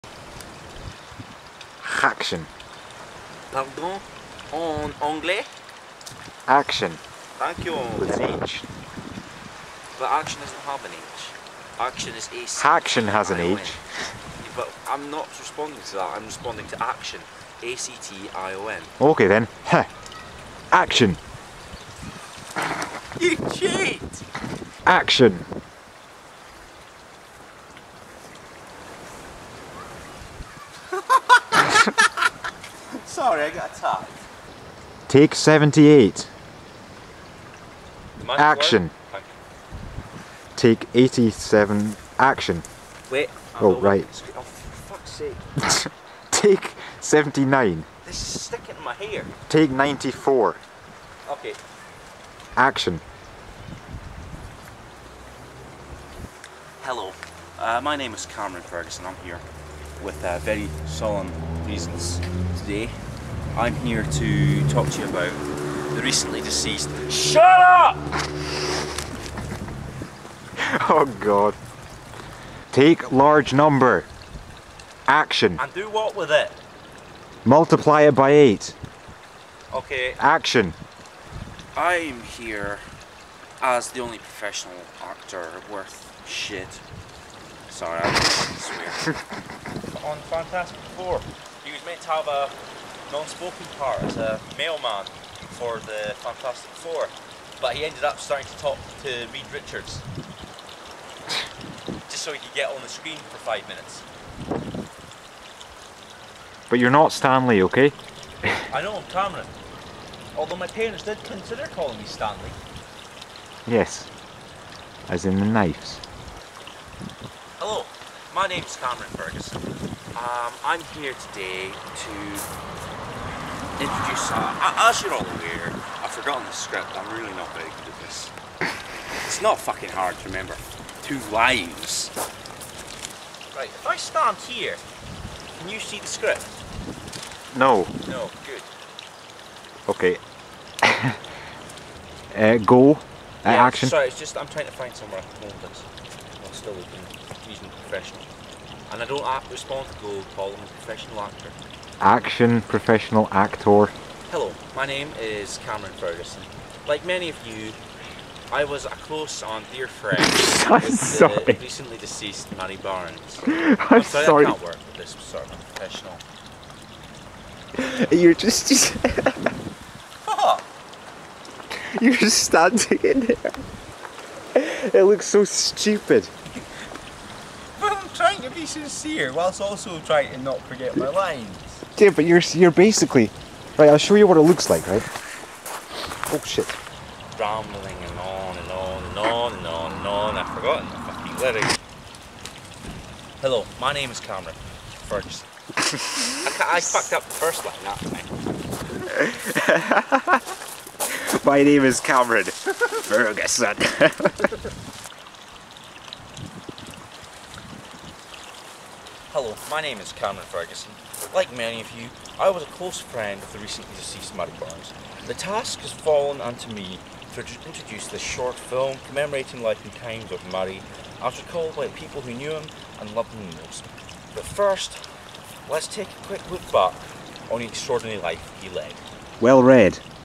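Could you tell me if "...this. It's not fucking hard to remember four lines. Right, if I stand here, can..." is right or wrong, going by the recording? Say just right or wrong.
wrong.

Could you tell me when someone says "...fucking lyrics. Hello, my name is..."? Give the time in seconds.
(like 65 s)
191 s.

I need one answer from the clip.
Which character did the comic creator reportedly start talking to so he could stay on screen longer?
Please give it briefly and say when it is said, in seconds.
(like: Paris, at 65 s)
Reed Richards, at 99 s.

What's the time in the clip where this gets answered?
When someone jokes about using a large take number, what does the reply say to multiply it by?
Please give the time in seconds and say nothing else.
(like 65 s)
78 s.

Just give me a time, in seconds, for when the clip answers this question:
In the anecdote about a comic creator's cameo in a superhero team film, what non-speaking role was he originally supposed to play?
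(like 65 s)
94 s.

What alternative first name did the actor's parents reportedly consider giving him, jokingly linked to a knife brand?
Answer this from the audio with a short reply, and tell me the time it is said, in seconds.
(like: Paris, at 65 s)
Stanley, at 112 s.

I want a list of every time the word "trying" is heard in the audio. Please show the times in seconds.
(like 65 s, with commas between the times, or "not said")
144 s, 179 s.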